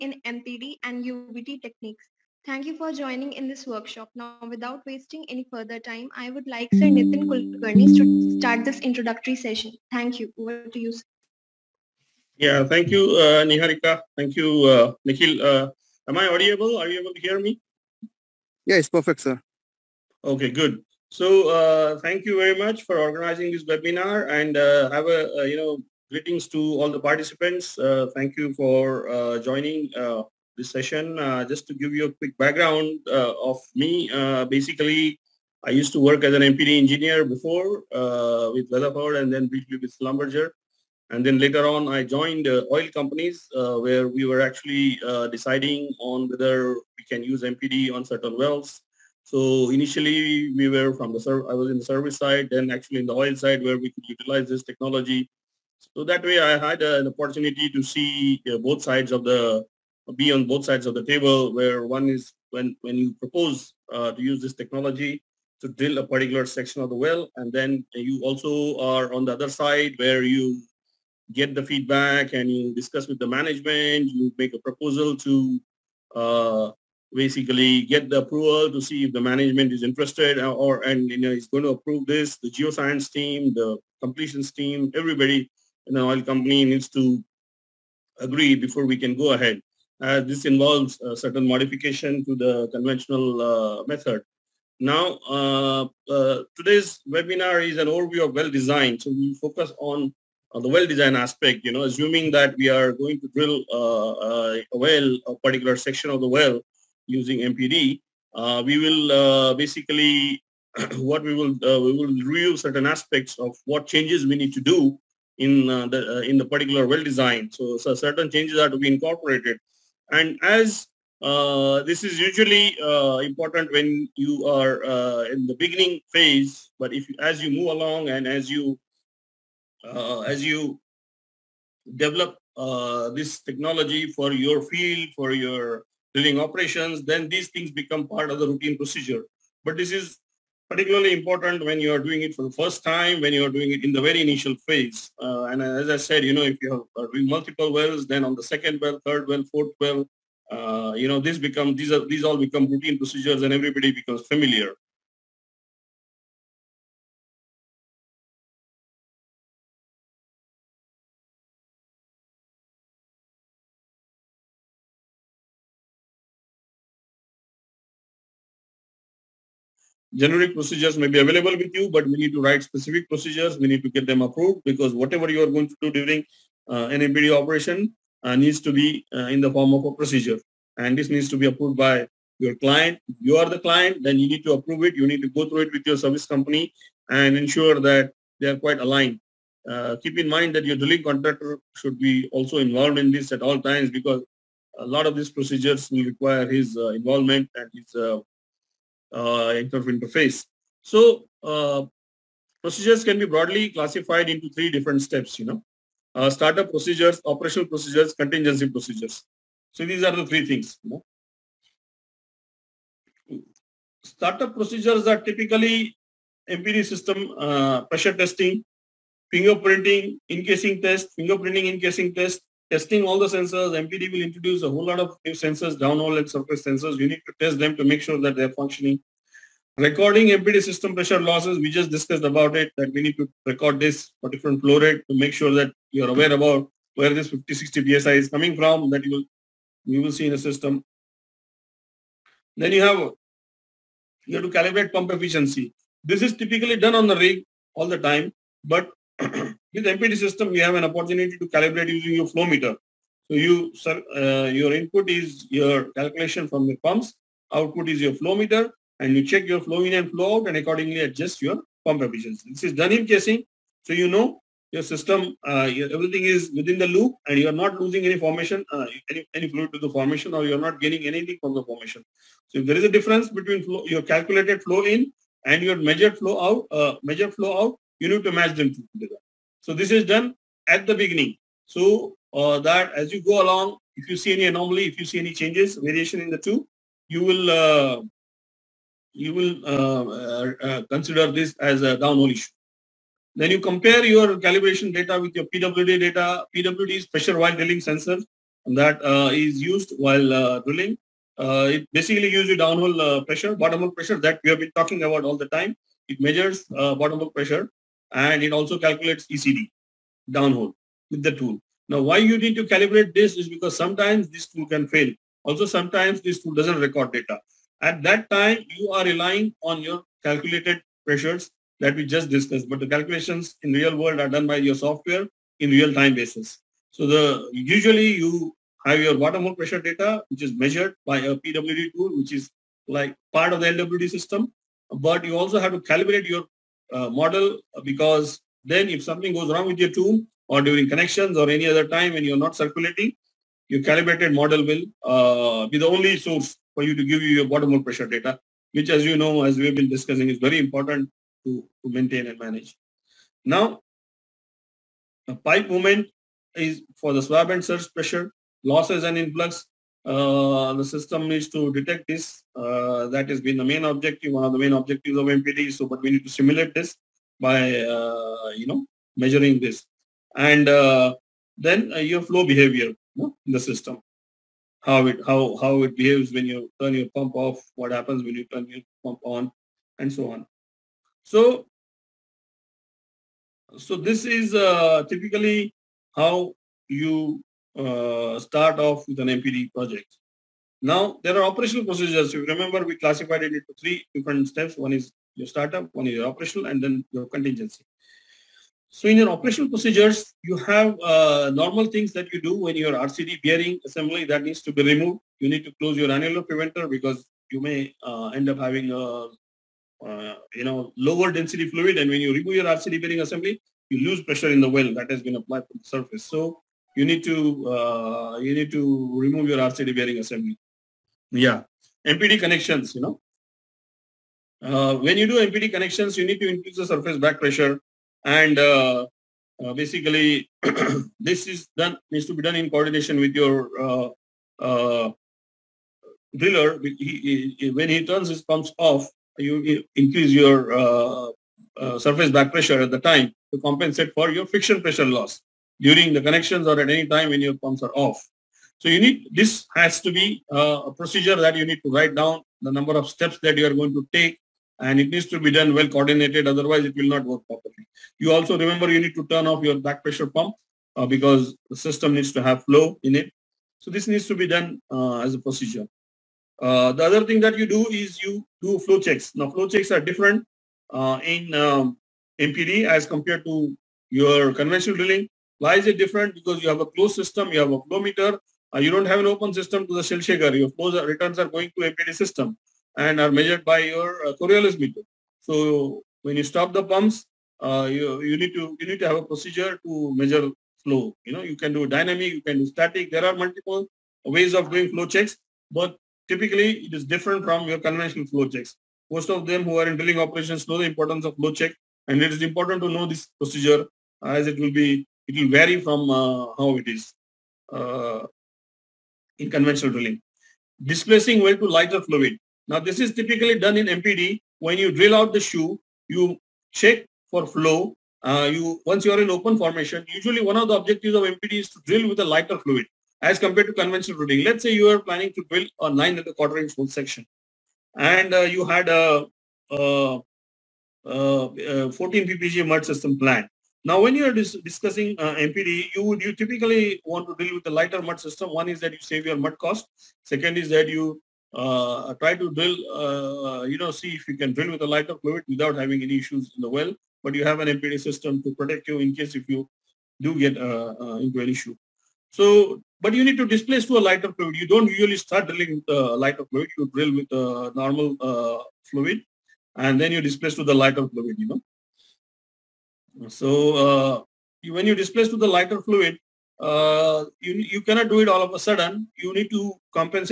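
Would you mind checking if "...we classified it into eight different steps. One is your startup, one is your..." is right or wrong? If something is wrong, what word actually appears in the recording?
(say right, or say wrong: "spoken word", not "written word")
wrong: "three", not "eight".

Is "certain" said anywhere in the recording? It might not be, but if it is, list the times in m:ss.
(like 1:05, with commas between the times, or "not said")
0:48, 1:31, 1:52, 1:57.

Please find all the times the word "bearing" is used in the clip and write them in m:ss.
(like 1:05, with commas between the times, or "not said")
6:43, 6:53, 6:59.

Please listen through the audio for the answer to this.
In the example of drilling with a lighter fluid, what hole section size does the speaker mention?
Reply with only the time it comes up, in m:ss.
8:45.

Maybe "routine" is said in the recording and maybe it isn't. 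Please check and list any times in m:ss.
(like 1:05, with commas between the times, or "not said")
2:18, 2:32.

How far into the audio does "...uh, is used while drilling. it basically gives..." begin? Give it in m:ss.
4:59.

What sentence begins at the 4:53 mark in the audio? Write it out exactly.
Then you compare your calibration data with your PWD data.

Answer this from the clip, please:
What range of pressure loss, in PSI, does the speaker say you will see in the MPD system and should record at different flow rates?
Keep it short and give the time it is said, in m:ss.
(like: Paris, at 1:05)
50-60 PSI, at 3:57.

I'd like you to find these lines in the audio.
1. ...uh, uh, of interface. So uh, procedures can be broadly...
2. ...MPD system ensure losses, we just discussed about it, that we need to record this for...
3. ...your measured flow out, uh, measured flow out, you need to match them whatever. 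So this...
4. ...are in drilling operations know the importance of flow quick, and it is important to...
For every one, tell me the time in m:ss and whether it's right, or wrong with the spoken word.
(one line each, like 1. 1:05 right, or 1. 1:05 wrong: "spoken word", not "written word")
1. 3:17 right
2. 3:50 wrong: "pressure", not "ensure"
3. 4:35 wrong: "together", not "whatever"
4. 8:19 wrong: "check", not "quick".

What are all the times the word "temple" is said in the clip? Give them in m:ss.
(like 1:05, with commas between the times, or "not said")
not said.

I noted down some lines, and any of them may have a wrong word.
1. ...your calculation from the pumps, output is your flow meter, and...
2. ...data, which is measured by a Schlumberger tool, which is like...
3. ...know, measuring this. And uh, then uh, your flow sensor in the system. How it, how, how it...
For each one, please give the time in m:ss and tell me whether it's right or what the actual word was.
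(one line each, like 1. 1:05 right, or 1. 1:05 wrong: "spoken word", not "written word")
1. 4:15 right
2. 5:29 wrong: "PWD", not "Schlumberger"
3. 6:08 wrong: "behavior", not "sensor".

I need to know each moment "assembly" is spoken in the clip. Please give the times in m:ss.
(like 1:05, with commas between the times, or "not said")
6:43, 6:53, 7:00.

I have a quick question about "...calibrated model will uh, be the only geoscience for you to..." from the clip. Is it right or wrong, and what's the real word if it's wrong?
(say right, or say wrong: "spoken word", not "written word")
wrong: "source", not "geoscience".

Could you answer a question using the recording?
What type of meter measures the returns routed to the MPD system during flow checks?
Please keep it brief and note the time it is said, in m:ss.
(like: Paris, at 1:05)
Coriolis meter, at 8:04.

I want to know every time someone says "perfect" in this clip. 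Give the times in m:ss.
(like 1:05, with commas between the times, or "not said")
0:18.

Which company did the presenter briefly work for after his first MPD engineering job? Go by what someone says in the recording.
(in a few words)
Schlumberger.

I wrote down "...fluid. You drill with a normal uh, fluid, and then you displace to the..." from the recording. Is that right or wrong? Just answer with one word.
right.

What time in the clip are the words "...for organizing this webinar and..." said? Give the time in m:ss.
0:22.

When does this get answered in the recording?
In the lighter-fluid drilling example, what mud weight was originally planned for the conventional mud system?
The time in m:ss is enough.
8:51.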